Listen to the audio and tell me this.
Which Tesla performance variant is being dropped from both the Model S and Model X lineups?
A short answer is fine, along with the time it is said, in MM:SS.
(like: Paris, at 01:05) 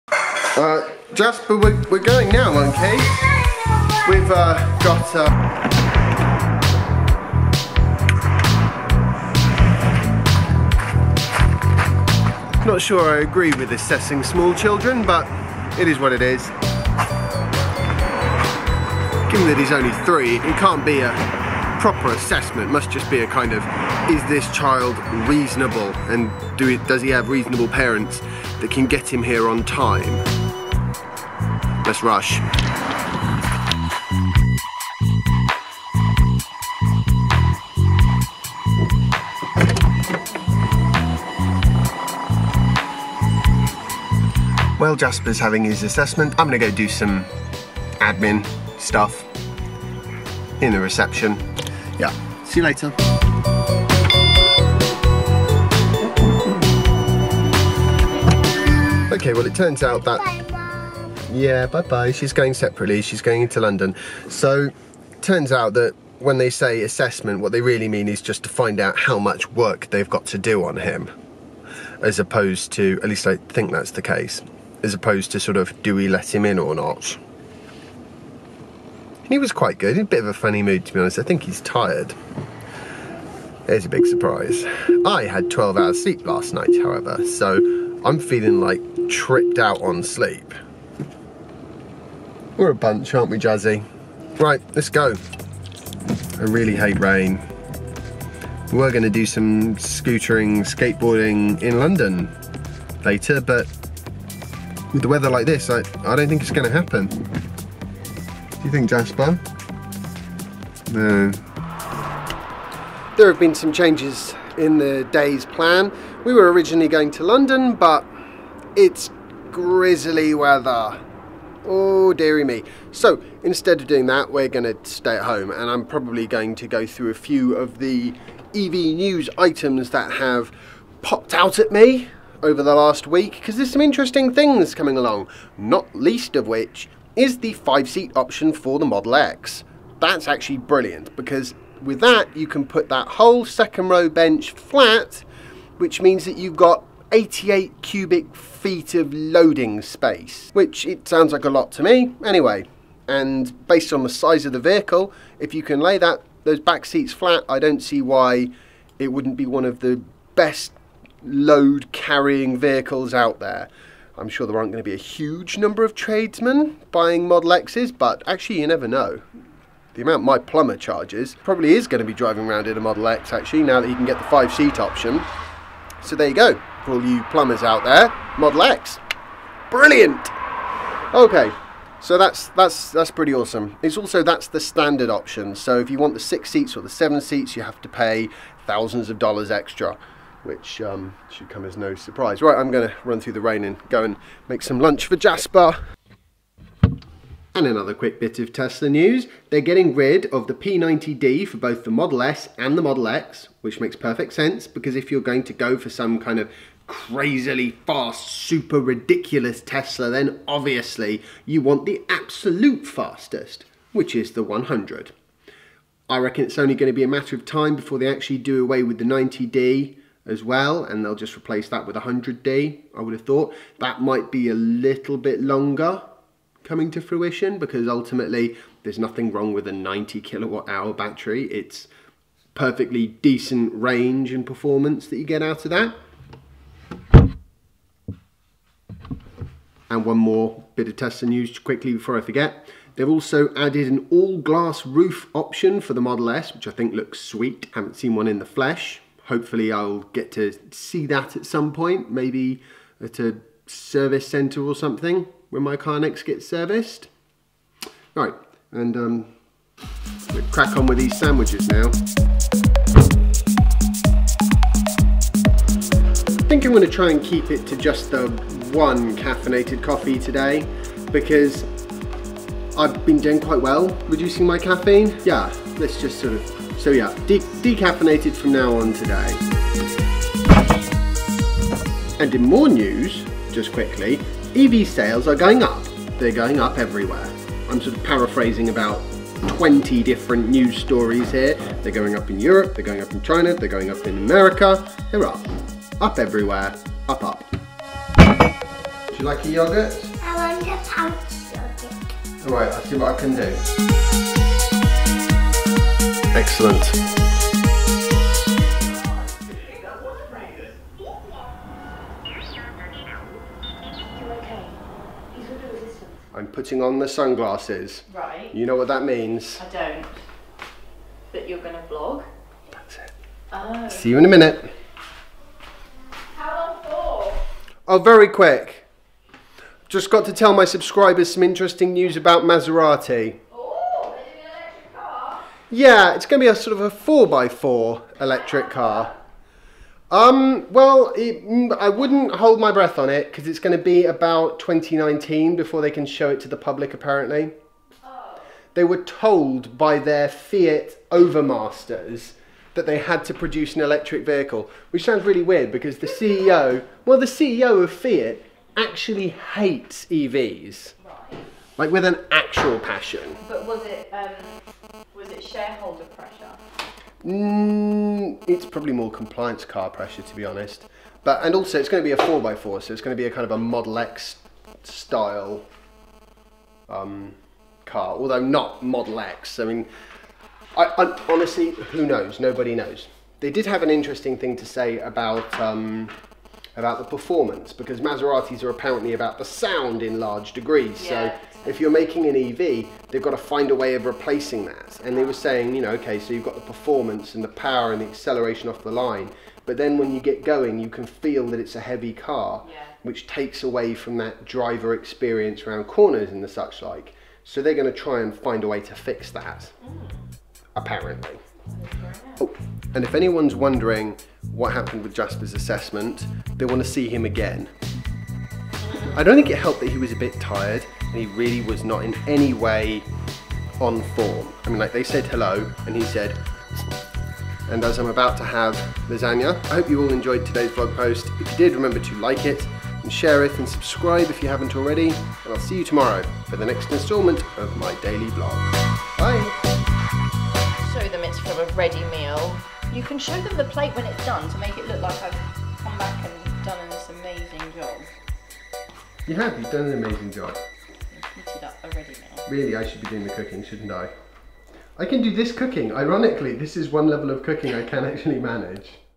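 P90D, at 03:20.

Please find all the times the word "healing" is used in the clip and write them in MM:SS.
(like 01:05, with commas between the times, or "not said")
not said.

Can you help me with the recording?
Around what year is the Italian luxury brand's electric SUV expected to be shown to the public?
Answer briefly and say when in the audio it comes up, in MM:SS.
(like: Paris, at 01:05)
2019, at 05:44.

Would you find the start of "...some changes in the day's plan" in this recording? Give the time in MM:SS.
01:53.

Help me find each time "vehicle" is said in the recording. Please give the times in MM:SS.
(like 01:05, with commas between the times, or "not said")
02:34, 02:42, 05:54.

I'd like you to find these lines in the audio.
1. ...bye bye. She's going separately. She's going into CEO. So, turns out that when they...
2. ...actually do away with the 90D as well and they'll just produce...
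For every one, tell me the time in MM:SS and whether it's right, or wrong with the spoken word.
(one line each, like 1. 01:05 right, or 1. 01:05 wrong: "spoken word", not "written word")
1. 01:01 wrong: "London", not "CEO"
2. 03:38 wrong: "replace", not "produce".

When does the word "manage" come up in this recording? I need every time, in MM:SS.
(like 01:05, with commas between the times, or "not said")
07:38.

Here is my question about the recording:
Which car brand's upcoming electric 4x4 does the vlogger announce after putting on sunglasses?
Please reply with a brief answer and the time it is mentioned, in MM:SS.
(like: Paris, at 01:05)
Maserati, at 05:32.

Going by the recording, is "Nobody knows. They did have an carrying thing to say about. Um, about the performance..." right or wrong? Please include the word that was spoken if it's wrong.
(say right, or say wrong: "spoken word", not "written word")
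wrong: "interesting", not "carrying".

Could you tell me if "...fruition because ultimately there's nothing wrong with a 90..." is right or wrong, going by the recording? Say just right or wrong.
right.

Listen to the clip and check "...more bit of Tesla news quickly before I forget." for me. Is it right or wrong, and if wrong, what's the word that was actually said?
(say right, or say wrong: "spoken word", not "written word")
right.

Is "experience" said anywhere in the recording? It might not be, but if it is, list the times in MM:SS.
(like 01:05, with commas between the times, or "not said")
06:44.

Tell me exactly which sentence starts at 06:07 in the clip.
Mm, it's probably more compliance car pressure, to be honest.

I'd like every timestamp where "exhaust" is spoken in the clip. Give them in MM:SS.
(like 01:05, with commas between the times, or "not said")
not said.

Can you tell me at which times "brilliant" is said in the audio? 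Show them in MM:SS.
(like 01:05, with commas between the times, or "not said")
02:20, 02:59.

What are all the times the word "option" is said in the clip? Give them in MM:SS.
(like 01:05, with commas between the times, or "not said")
02:18, 02:54, 03:05, 04:05.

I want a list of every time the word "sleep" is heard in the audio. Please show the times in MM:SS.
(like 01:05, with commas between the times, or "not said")
01:26, 01:30.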